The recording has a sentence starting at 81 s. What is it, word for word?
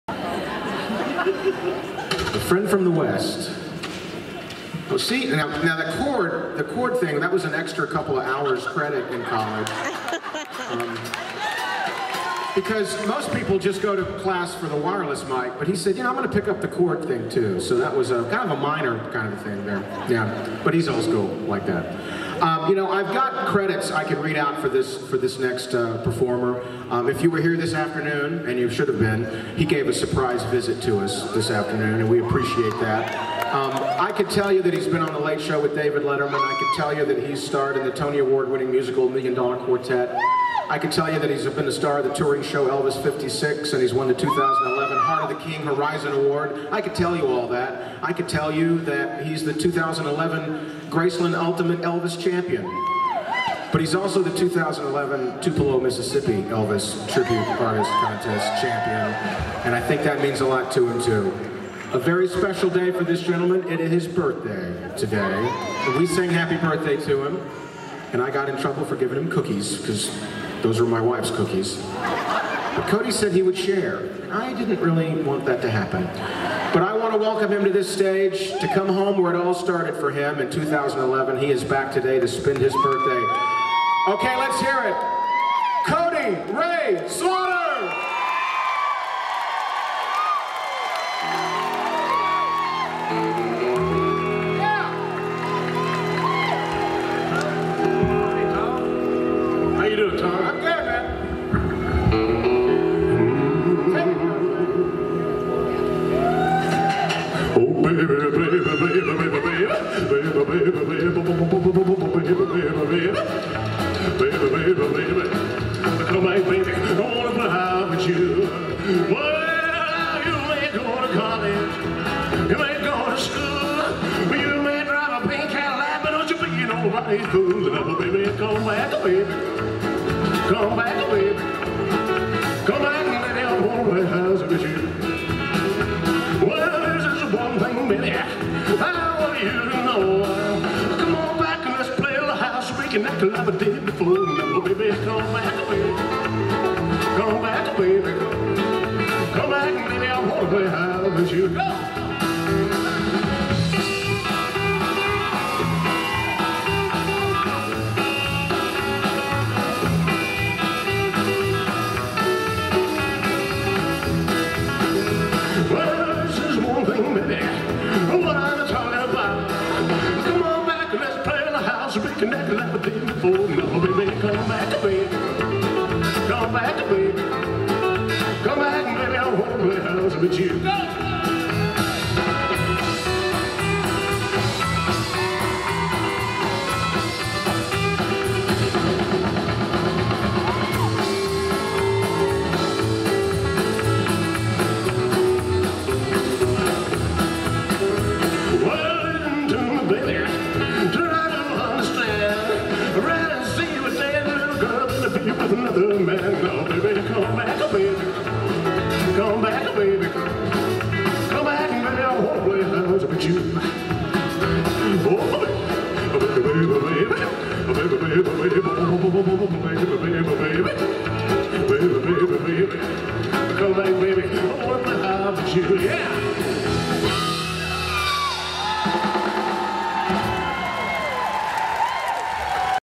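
He is back today to spend his birthday.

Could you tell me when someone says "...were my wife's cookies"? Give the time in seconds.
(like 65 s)
70 s.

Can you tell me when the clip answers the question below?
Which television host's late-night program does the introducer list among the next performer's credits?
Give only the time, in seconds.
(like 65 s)
35 s.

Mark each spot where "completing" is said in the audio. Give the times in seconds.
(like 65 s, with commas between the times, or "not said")
not said.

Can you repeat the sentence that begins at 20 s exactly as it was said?
Yeah, but he's old school like that.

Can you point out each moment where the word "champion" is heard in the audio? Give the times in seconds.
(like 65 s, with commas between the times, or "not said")
52 s, 58 s.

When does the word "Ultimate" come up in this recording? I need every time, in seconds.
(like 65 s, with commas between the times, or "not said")
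51 s.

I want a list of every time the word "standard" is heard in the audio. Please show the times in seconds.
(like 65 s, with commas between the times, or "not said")
not said.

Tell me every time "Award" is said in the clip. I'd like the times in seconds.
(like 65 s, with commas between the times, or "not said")
38 s, 46 s.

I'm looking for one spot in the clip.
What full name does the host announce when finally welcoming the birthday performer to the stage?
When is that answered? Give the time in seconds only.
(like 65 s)
85 s.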